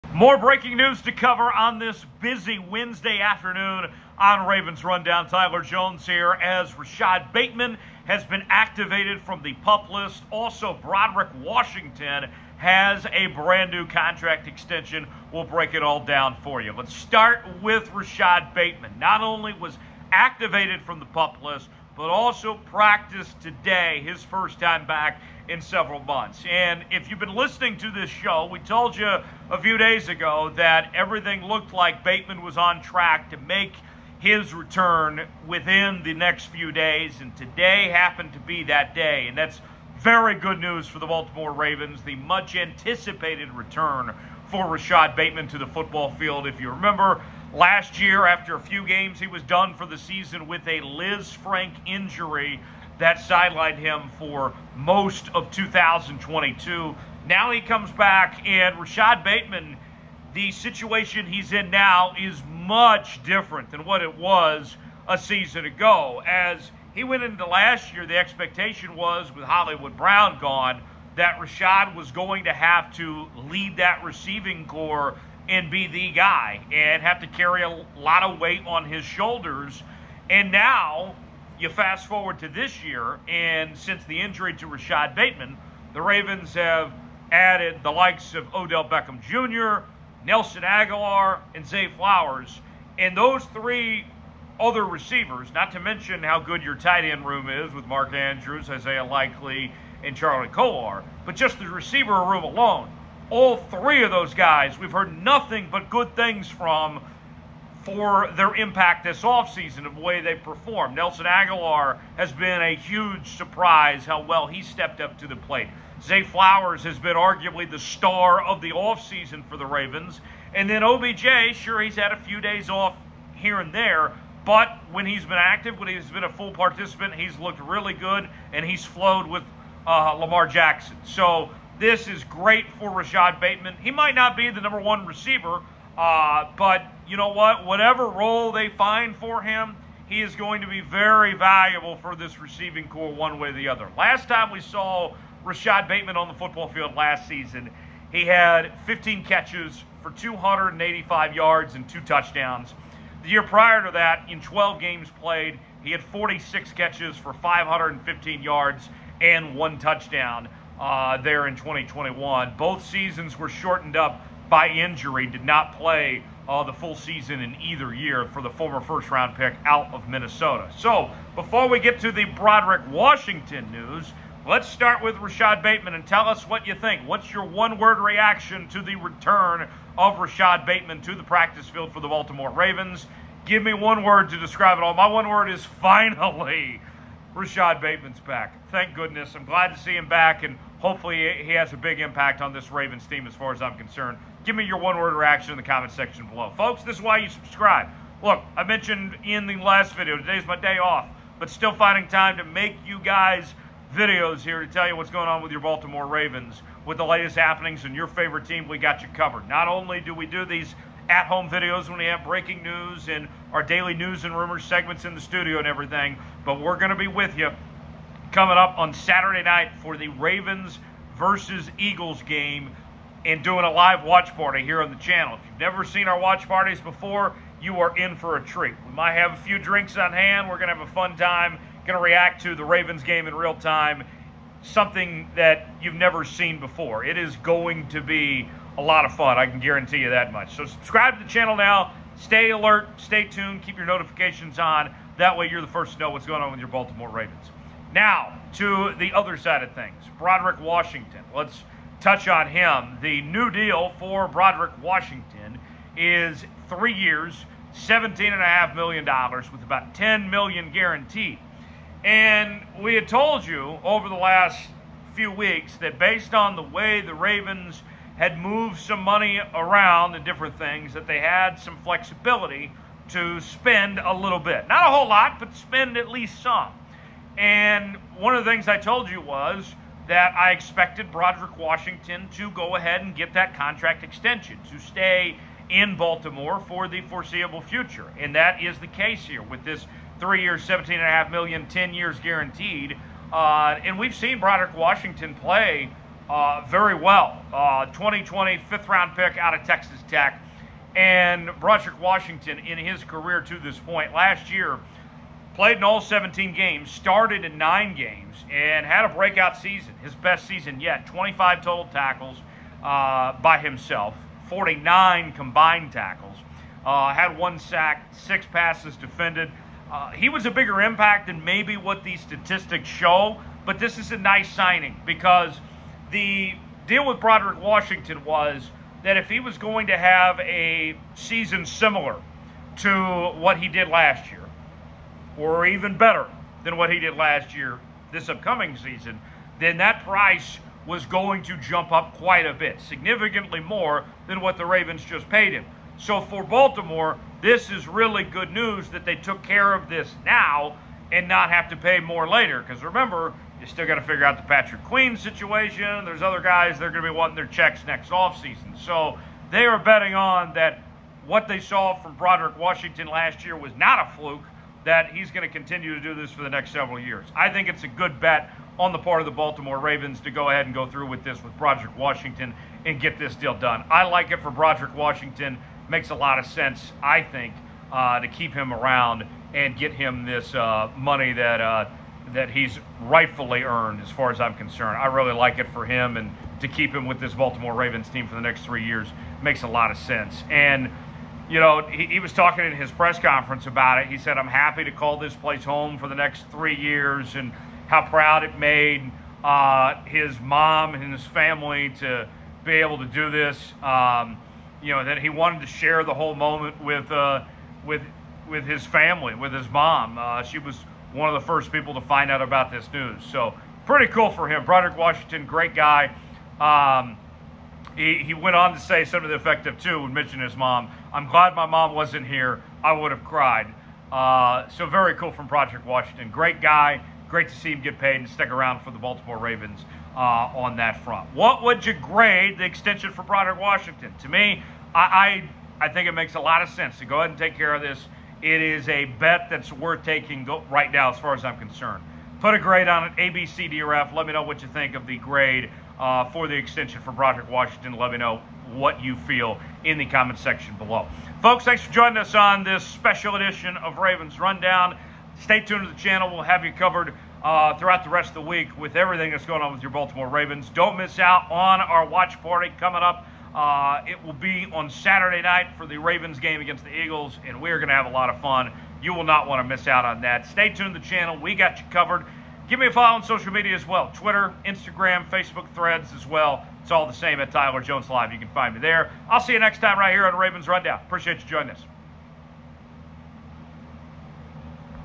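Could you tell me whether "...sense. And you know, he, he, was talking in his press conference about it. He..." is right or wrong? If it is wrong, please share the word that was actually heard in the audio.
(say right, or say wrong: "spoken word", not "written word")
right.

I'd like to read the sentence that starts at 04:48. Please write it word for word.
And that is the case here with this three years, 17 and a half million, 10 years guaranteed.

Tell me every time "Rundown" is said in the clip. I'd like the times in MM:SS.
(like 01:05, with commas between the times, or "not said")
00:04, 07:34, 08:00.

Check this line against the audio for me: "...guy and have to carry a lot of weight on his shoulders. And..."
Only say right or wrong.
right.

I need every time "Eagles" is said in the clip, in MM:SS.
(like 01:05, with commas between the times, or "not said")
03:41, 07:46.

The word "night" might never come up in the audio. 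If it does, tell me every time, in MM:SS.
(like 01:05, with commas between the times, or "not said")
03:39, 07:45.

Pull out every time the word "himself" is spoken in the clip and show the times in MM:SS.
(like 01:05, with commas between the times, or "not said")
05:13.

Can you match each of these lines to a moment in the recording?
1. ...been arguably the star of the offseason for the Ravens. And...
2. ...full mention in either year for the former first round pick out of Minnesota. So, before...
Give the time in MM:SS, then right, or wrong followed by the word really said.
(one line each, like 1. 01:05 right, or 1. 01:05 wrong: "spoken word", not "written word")
1. 01:56 right
2. 02:46 wrong: "season", not "mention".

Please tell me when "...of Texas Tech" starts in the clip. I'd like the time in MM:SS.
04:59.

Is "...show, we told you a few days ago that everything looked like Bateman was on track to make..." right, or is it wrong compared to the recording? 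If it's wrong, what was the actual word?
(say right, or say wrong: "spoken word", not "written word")
right.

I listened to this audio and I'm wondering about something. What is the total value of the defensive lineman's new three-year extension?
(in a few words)
$17.5 million.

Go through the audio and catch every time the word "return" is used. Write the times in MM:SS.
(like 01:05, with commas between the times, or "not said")
00:34, 00:43, 02:58.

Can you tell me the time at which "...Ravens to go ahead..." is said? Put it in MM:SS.
06:09.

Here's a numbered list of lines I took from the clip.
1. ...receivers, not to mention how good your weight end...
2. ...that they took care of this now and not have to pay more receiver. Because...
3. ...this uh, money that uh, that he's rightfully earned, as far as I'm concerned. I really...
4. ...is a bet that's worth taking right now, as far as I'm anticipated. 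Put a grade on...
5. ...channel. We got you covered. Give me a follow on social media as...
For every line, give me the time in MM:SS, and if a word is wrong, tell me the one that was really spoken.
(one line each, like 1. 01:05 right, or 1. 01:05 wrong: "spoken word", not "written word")
1. 01:34 wrong: "tight", not "weight"
2. 05:48 wrong: "later", not "receiver"
3. 06:20 right
4. 07:18 wrong: "concerned", not "anticipated"
5. 07:51 right.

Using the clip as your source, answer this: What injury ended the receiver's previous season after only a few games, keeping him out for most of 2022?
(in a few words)
Lisfranc injury.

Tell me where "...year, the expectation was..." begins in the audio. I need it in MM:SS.
01:07.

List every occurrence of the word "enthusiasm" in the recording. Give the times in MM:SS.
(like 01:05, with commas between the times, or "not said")
not said.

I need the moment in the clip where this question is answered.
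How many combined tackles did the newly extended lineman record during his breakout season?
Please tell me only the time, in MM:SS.
05:14.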